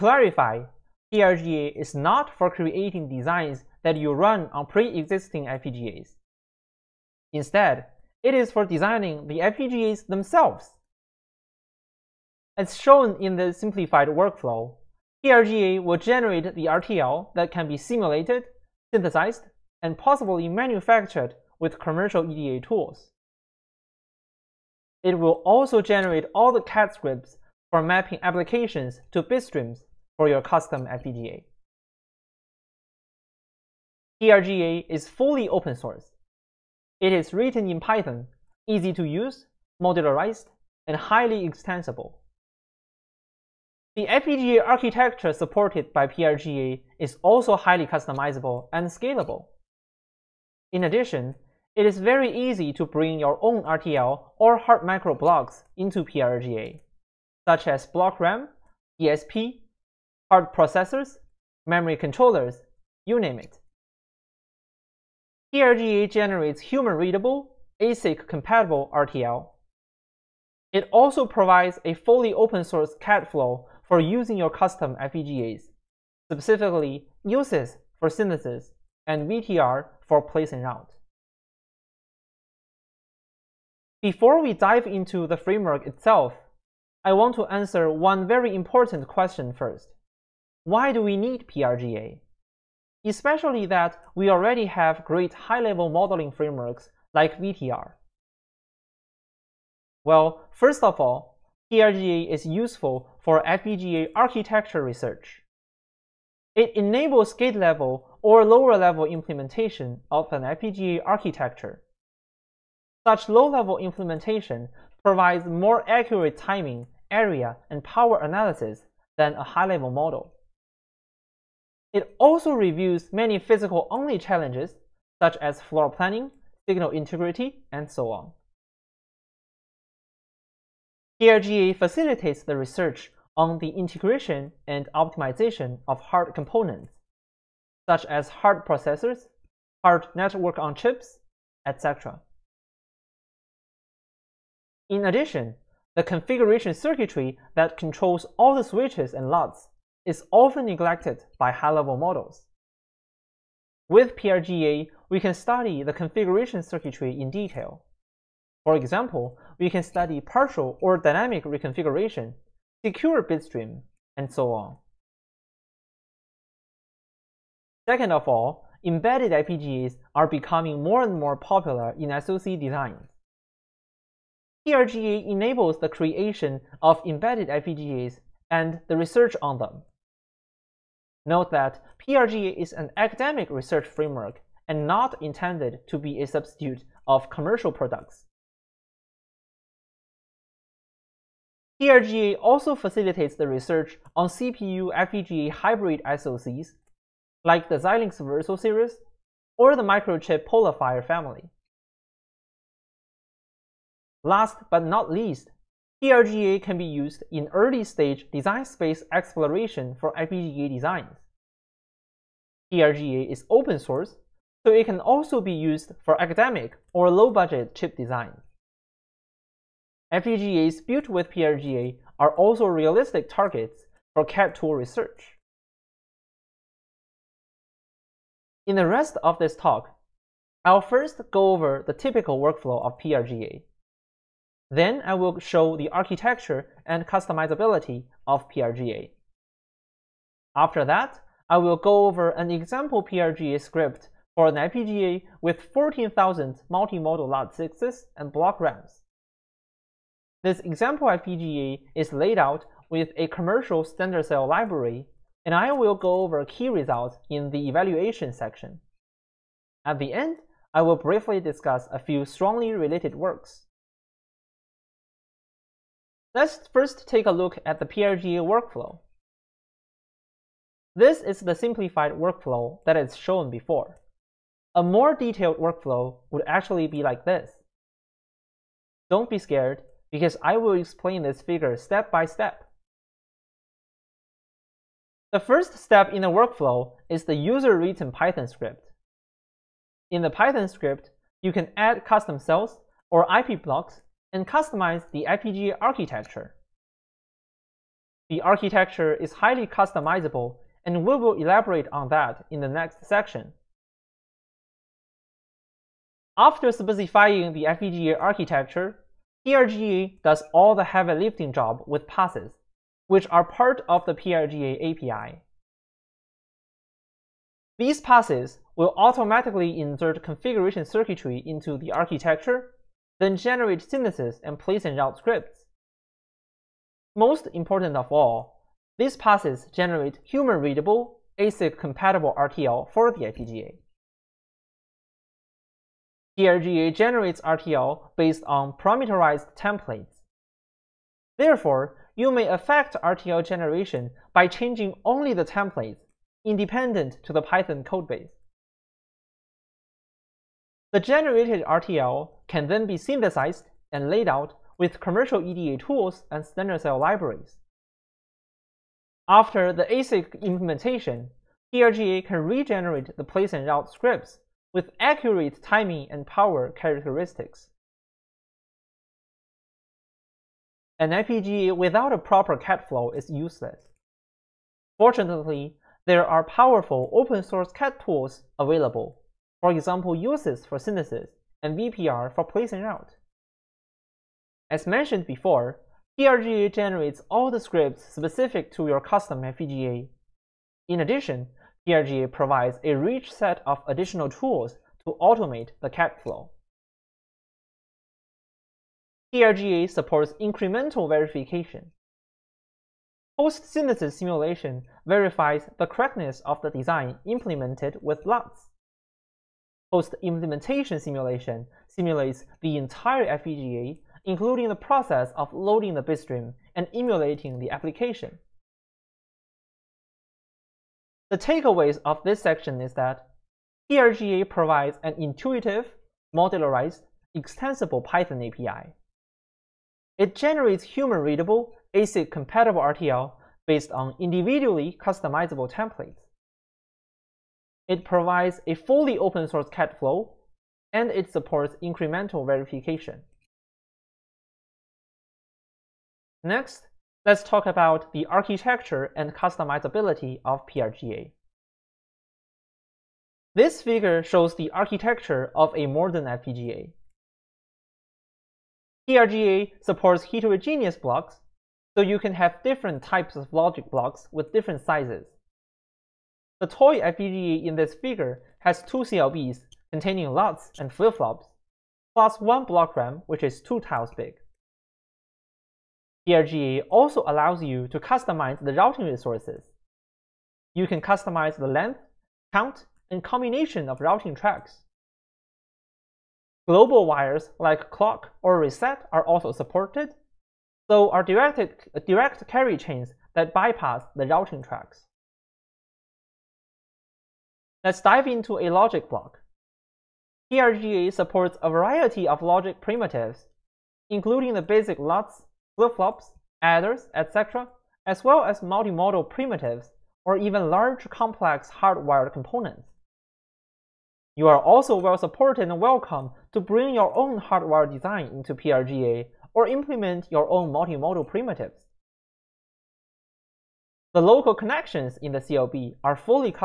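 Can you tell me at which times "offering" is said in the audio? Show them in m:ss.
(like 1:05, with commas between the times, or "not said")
not said.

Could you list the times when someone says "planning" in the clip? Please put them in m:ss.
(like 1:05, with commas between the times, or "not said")
2:05.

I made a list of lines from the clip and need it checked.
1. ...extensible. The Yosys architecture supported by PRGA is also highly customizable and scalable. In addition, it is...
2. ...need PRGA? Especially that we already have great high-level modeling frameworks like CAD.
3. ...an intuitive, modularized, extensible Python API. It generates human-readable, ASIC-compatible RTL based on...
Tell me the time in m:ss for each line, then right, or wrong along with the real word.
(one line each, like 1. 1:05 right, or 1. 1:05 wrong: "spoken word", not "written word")
1. 0:41 wrong: "FPGA", not "Yosys"
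2. 1:31 wrong: "VTR", not "CAD"
3. 7:05 right.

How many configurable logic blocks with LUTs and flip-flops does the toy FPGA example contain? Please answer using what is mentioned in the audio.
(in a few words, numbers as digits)
2.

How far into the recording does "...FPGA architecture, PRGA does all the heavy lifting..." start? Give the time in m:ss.
5:07.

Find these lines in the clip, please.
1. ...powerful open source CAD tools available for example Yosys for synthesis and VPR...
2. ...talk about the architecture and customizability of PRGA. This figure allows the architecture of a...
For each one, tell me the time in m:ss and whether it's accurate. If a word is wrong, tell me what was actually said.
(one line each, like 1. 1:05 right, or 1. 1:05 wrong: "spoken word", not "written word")
1. 6:16 right
2. 7:27 wrong: "shows", not "allows".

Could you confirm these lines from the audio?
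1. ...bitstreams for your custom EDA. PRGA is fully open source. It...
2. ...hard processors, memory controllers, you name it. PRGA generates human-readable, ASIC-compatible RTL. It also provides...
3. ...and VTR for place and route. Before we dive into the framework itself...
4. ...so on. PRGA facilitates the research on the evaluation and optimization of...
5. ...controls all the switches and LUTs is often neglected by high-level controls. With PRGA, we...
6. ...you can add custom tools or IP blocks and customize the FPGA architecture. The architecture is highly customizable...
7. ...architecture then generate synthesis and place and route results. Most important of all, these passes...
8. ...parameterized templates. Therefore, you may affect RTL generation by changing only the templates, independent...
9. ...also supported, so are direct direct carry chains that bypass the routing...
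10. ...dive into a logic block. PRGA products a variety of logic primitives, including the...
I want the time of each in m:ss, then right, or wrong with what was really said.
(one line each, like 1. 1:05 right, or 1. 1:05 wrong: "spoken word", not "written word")
1. 0:29 wrong: "FPGA", not "EDA"
2. 1:00 right
3. 1:19 right
4. 2:07 wrong: "integration", not "evaluation"
5. 2:27 wrong: "models", not "controls"
6. 4:51 wrong: "cells", not "tools"
7. 5:21 wrong: "scripts", not "results"
8. 5:38 right
9. 8:09 right
10. 8:17 wrong: "supports", not "products".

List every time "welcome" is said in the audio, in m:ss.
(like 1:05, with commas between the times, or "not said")
8:35.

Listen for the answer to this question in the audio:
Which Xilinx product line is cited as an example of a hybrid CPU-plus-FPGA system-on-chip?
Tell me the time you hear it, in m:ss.
3:18.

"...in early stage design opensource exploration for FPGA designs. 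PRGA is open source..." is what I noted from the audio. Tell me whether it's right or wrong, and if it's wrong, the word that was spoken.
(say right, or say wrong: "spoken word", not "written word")
wrong: "space", not "opensource".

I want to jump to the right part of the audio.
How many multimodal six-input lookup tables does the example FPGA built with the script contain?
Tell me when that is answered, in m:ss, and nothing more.
4:05.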